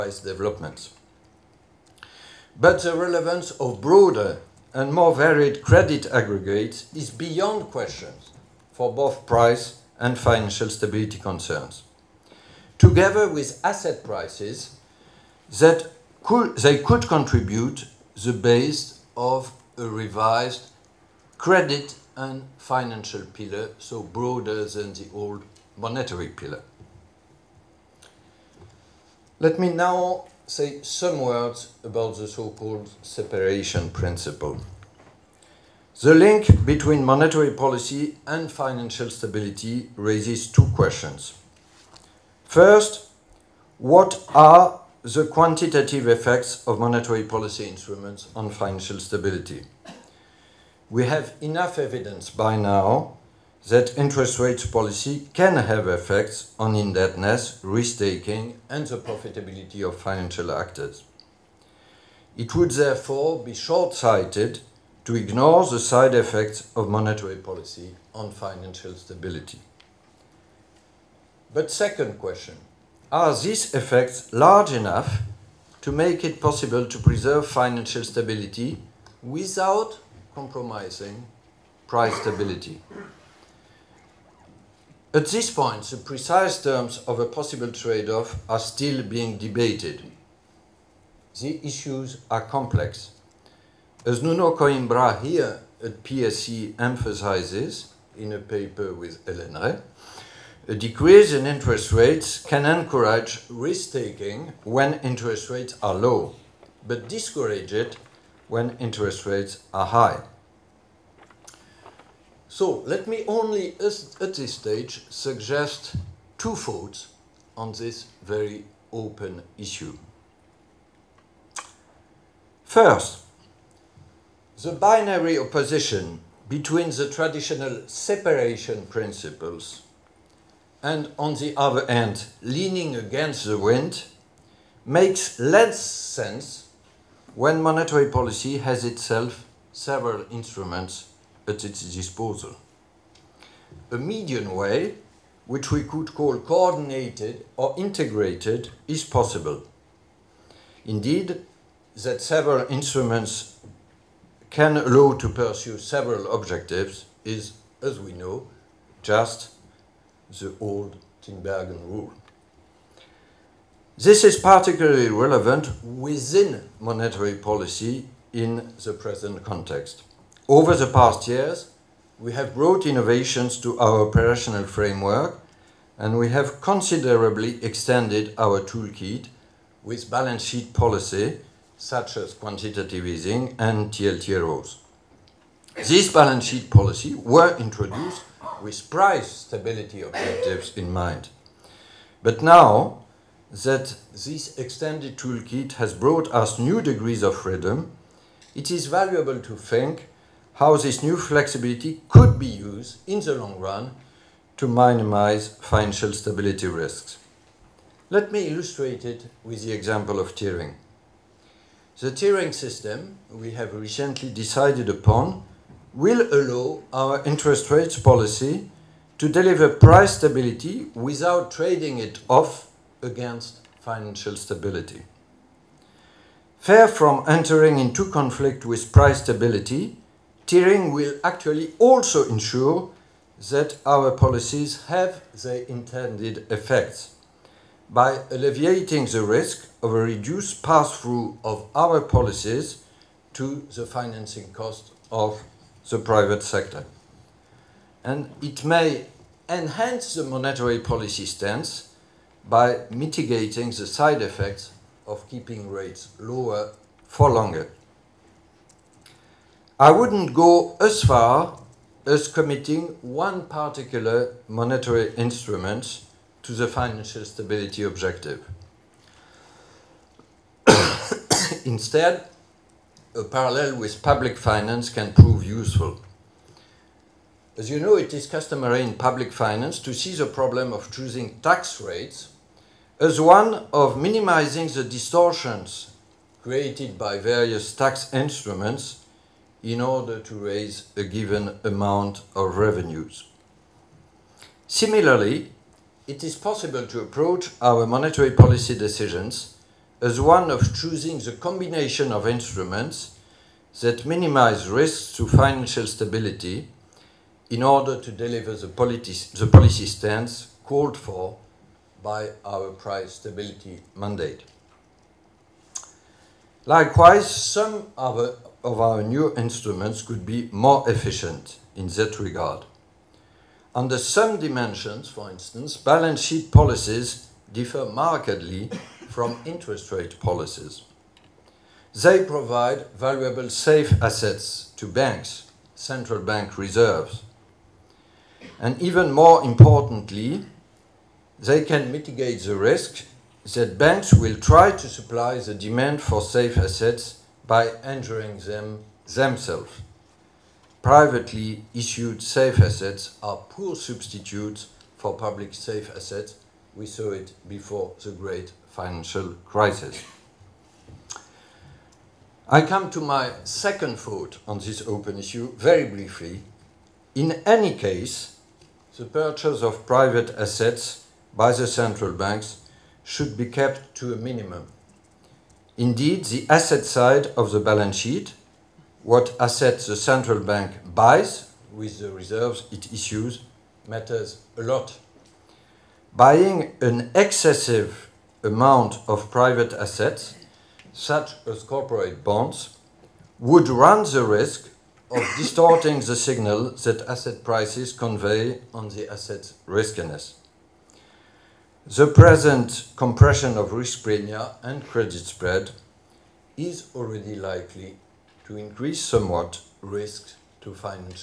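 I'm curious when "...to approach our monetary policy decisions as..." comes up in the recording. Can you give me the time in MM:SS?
04:56.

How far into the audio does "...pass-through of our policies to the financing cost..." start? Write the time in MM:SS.
04:00.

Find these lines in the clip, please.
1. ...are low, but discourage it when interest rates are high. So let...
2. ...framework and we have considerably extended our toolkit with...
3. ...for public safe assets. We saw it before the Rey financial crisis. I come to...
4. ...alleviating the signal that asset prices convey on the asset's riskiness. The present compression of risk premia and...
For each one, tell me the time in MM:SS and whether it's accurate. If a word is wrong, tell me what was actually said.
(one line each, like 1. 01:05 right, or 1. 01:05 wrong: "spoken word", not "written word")
1. 01:45 right
2. 02:54 right
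3. 05:54 wrong: "Great", not "Rey"
4. 06:35 wrong: "distorting", not "alleviating".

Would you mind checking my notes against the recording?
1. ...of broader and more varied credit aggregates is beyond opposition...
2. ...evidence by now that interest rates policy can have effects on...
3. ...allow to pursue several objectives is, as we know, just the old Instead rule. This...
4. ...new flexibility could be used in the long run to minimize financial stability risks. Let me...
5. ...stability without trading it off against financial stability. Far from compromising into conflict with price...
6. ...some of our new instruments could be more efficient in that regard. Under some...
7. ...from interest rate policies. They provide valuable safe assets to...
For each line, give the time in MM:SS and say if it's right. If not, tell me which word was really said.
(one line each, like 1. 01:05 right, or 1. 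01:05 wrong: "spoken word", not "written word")
1. 00:03 wrong: "question", not "opposition"
2. 00:51 right
3. 02:34 wrong: "Tinbergen", not "Instead"
4. 03:21 right
5. 03:40 wrong: "entering", not "compromising"
6. 05:17 right
7. 05:29 right.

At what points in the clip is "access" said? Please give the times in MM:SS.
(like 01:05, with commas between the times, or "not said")
not said.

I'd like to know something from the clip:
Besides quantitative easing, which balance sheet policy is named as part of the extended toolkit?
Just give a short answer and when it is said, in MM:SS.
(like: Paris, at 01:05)
TLTROs, at 03:03.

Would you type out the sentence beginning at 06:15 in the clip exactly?
Indeed, the asset side of the balance sheet, what assets the central bank buys with the reserves it issues, matters a lot.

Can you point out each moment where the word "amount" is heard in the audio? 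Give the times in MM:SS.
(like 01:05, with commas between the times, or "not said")
04:51, 06:28.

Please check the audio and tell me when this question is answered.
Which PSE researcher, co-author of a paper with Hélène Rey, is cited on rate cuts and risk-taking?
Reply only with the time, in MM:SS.
01:34.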